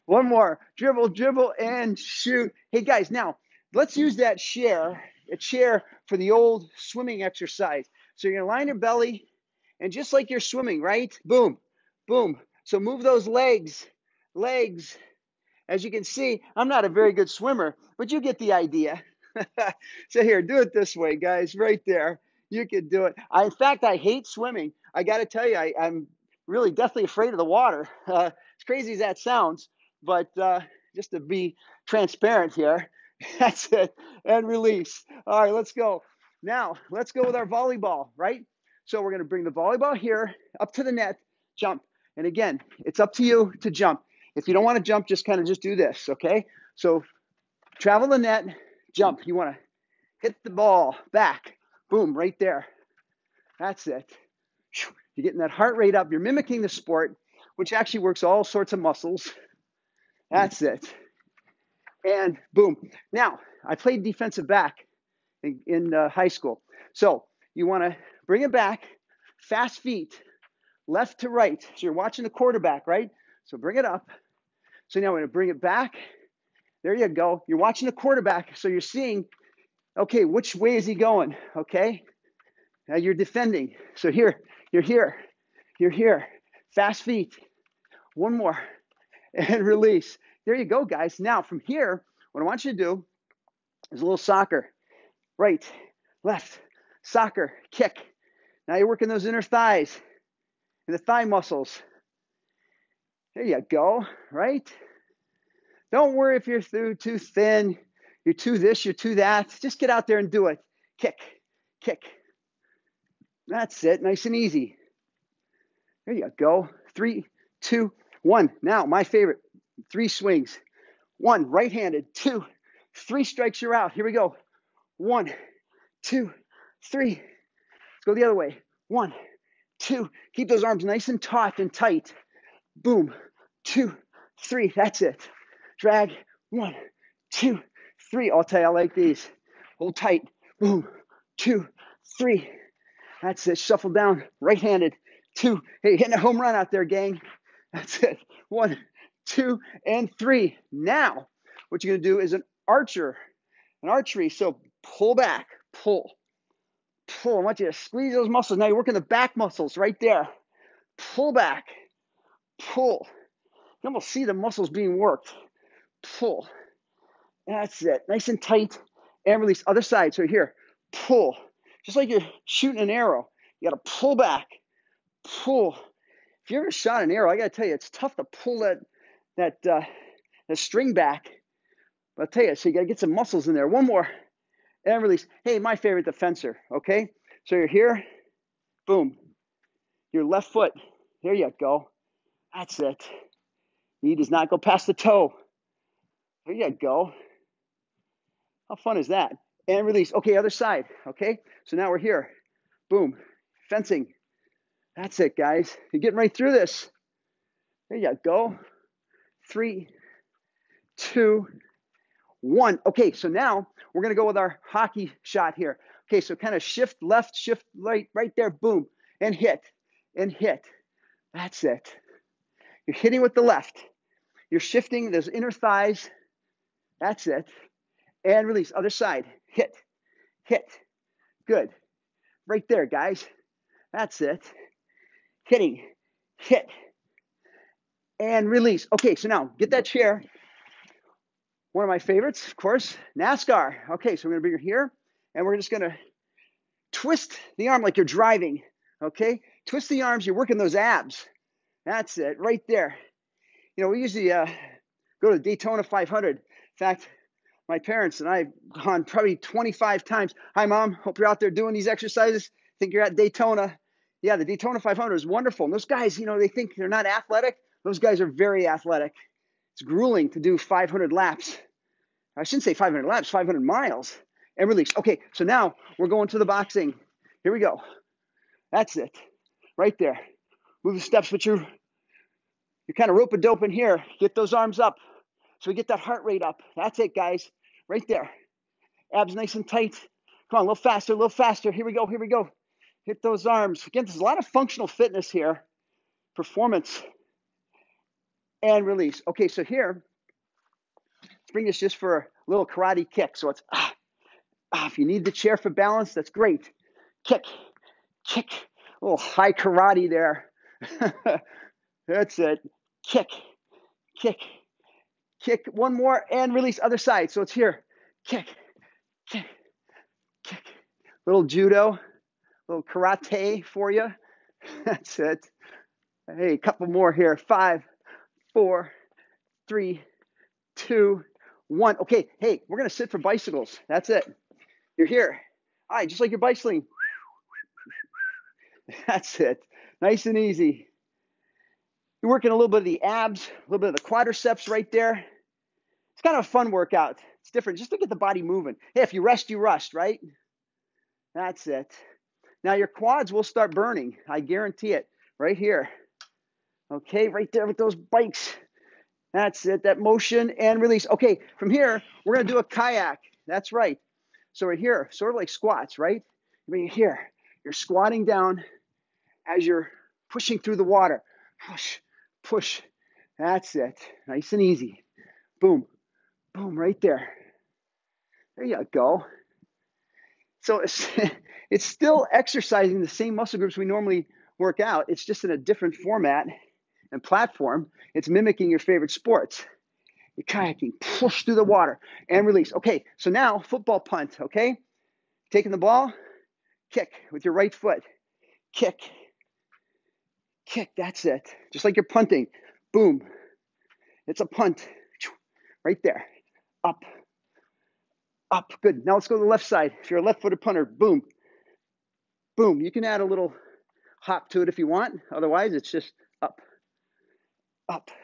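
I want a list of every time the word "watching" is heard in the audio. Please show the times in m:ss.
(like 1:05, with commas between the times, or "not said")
1:11, 1:17.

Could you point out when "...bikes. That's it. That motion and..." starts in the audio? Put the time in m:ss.
5:57.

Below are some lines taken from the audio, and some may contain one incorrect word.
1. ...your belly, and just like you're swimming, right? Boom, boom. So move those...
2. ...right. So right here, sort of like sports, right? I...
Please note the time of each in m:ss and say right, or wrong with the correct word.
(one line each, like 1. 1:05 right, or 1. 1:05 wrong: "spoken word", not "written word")
1. 0:08 right
2. 6:03 wrong: "squats", not "sports".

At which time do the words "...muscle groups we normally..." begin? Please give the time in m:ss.
6:23.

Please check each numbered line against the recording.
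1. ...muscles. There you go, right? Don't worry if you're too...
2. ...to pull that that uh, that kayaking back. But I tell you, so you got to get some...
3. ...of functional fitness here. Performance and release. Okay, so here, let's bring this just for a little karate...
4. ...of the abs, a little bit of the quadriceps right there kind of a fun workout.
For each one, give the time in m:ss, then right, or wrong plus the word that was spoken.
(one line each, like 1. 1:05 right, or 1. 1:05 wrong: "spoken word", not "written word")
1. 1:41 right
2. 2:58 wrong: "string", not "kayaking"
3. 4:54 right
4. 5:42 right.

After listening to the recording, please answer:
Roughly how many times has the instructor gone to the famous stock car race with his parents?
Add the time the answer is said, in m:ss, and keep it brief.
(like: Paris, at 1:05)
25, at 4:19.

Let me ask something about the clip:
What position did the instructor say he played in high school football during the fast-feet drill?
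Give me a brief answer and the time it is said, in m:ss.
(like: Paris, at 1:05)
Defensive back, at 1:04.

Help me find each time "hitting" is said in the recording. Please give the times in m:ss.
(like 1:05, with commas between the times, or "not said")
2:25, 3:42, 3:55.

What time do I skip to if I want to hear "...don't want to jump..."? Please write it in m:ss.
0:44.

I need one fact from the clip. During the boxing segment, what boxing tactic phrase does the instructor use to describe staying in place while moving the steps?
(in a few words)
Rope a dope.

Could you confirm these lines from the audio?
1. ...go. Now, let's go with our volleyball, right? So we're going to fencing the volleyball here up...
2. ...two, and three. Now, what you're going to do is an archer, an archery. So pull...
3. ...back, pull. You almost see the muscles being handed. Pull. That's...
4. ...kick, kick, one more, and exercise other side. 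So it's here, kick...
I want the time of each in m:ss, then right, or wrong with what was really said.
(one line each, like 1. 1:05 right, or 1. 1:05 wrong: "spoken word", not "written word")
1. 0:35 wrong: "bring", not "fencing"
2. 2:29 right
3. 2:41 wrong: "worked", not "handed"
4. 5:14 wrong: "release", not "exercise".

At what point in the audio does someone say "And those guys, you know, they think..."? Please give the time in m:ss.
4:25.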